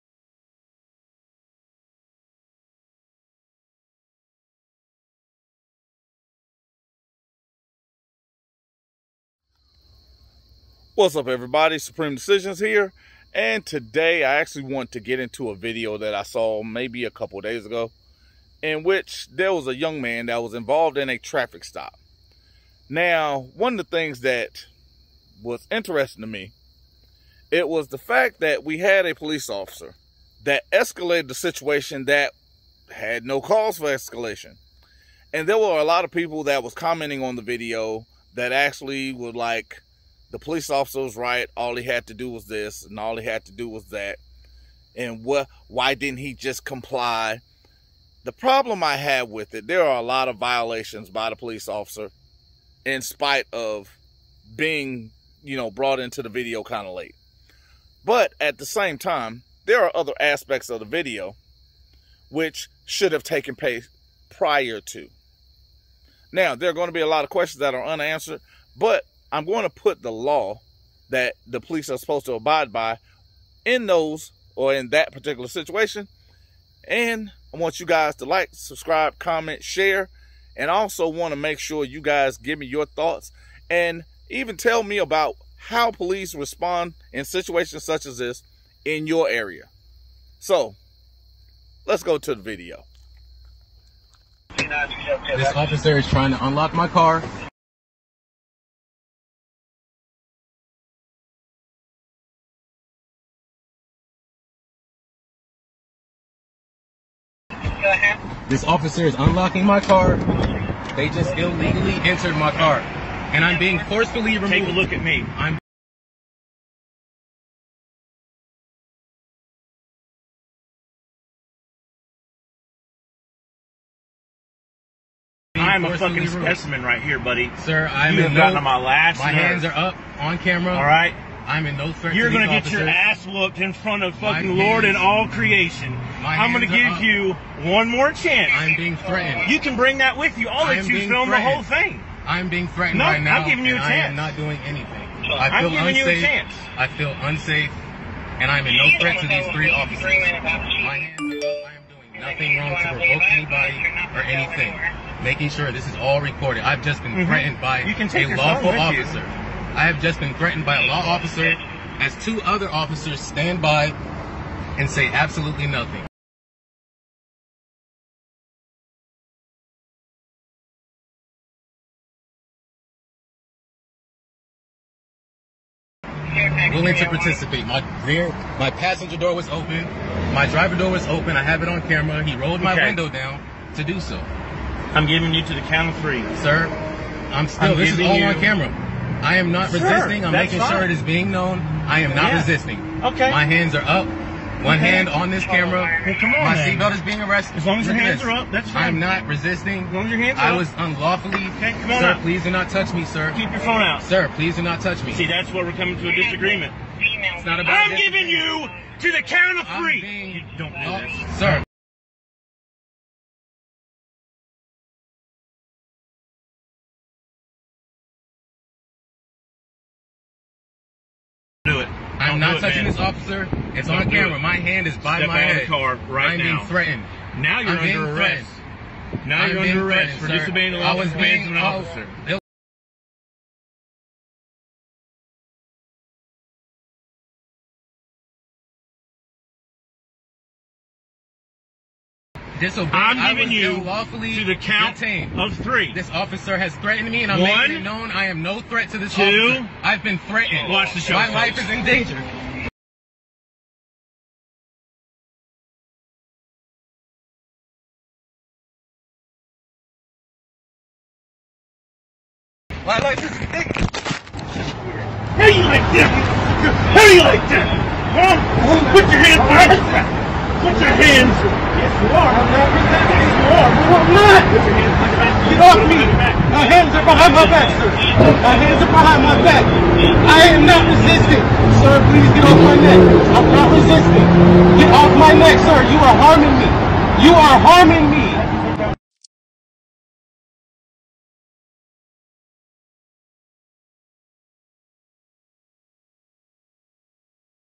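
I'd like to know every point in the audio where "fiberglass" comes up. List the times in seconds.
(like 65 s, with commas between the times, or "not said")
not said.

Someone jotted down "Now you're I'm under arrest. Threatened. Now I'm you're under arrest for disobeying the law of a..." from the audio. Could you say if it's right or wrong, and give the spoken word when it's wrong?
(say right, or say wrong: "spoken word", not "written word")
right.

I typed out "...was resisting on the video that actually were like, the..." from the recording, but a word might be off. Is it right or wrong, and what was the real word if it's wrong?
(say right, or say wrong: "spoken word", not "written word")
wrong: "commenting", not "resisting".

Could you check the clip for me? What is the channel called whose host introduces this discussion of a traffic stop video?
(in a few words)
Supreme Decisions.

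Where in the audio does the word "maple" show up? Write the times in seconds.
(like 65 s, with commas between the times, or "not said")
not said.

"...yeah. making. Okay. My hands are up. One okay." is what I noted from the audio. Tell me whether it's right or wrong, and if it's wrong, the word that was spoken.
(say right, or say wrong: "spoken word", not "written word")
wrong: "resisting", not "making".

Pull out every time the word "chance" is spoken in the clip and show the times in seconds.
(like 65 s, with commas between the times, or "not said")
138 s, 143 s.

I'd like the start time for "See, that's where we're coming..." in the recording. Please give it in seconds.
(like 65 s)
205 s.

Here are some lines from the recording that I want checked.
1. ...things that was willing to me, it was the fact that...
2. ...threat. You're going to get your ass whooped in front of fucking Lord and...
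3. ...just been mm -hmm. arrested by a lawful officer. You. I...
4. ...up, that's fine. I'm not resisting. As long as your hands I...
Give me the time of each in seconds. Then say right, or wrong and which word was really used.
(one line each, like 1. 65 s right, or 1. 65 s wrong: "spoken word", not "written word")
1. 23 s wrong: "interesting", not "willing"
2. 131 s right
3. 156 s wrong: "threatened", not "arrested"
4. 198 s right.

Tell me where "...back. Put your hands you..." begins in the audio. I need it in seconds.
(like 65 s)
269 s.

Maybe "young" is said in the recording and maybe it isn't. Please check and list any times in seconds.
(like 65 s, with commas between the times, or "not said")
19 s.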